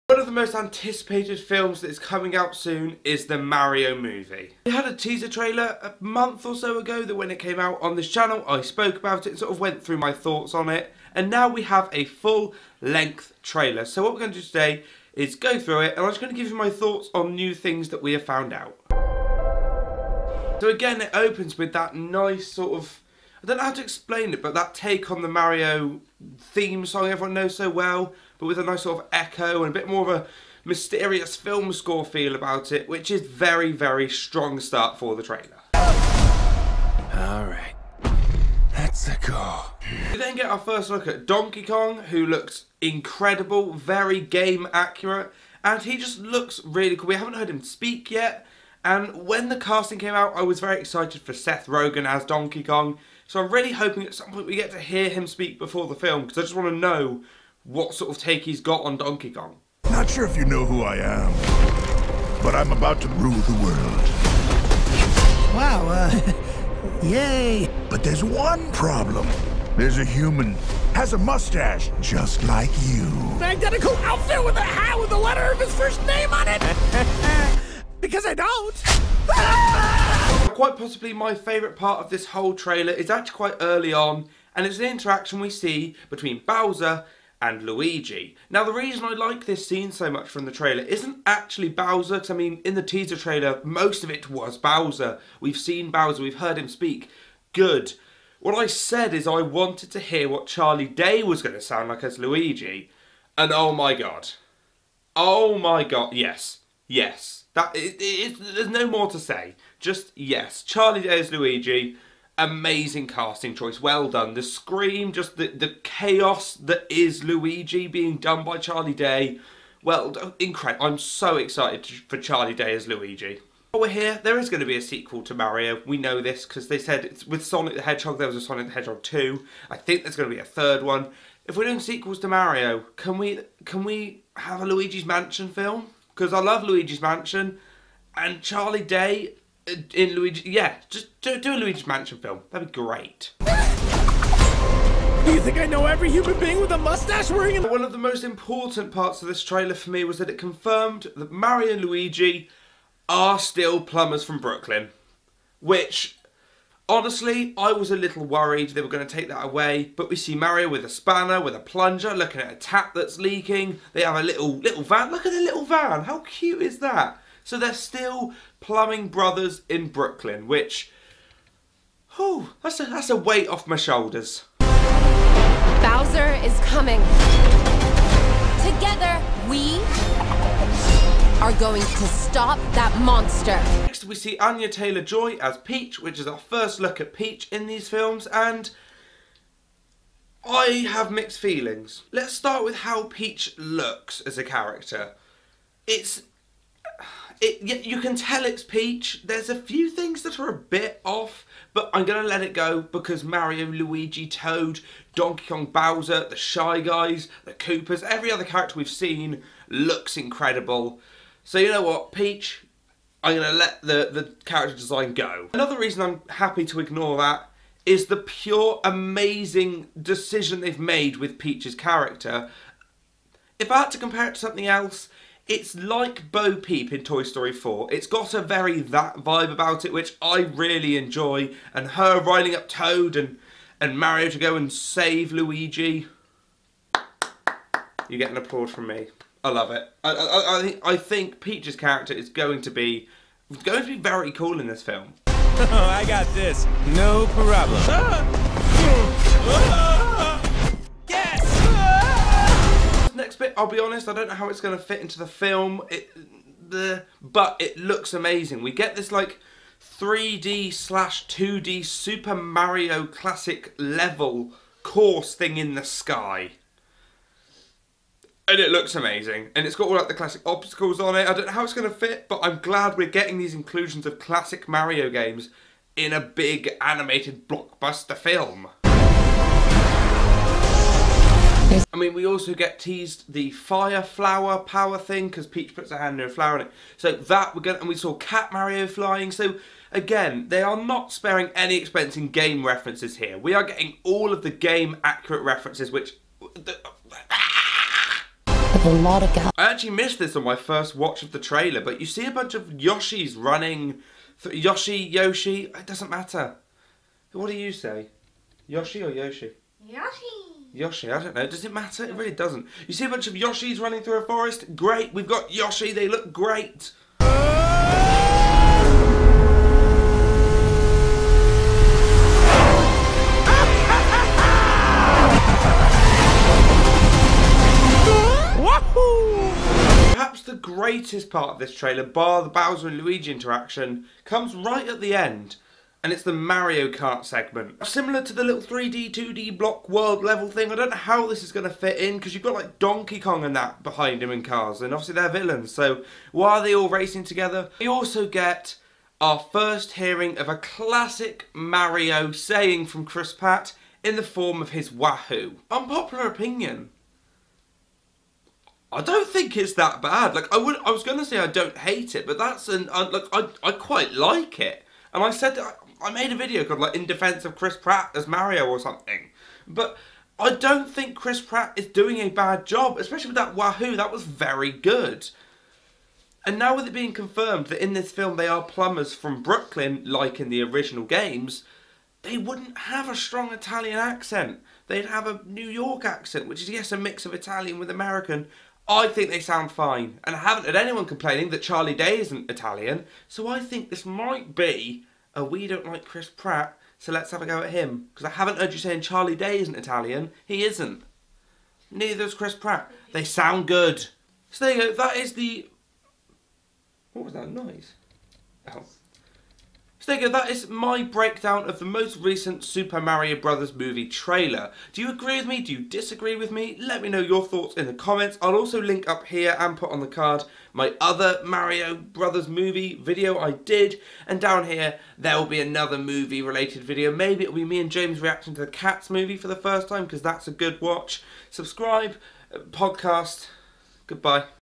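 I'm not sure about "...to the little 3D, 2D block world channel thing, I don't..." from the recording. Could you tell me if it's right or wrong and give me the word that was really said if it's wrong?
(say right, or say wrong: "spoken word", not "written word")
wrong: "level", not "channel".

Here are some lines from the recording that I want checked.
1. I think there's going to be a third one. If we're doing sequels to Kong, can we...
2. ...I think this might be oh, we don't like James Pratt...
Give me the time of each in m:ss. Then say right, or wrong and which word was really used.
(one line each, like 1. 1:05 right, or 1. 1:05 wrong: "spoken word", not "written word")
1. 2:09 wrong: "Mario", not "Kong"
2. 6:33 wrong: "Chris", not "James".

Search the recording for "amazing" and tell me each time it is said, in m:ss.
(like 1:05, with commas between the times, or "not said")
1:52, 3:38, 4:18, 4:28.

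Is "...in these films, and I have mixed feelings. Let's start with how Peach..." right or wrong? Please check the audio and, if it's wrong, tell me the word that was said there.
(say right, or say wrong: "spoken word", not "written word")
right.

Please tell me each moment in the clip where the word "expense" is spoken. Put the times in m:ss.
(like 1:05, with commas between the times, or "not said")
4:51.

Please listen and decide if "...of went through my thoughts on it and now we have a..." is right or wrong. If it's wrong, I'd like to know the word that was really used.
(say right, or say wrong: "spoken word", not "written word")
right.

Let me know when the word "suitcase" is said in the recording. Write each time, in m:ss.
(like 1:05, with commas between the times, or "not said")
not said.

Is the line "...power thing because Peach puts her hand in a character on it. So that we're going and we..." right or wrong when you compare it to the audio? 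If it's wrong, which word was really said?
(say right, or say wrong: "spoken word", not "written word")
wrong: "flower", not "character".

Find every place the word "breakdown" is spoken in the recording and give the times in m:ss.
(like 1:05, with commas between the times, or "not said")
6:51.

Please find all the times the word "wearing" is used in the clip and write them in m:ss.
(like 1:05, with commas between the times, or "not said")
2:27.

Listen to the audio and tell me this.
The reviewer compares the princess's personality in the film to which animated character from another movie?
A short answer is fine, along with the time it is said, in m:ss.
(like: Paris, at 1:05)
Bo Peep, at 3:46.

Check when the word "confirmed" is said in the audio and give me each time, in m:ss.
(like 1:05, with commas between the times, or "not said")
2:30, 6:17.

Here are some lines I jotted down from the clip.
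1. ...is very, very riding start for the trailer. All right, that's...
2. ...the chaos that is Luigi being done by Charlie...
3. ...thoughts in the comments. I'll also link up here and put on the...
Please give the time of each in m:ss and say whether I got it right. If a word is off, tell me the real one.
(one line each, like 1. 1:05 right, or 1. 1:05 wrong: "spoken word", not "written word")
1. 0:33 wrong: "strong", not "riding"
2. 1:55 right
3. 6:57 right.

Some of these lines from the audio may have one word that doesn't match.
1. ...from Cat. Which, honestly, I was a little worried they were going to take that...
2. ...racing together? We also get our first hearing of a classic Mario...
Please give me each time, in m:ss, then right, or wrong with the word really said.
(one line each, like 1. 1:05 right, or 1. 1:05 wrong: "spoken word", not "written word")
1. 2:34 wrong: "Brooklyn", not "Cat"
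2. 5:46 right.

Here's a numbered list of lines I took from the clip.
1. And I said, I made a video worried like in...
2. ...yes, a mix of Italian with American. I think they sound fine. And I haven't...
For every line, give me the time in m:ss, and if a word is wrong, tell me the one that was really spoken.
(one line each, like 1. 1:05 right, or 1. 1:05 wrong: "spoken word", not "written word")
1. 6:05 wrong: "called", not "worried"
2. 6:26 right.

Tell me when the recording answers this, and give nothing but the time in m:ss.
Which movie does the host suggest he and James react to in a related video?
7:08.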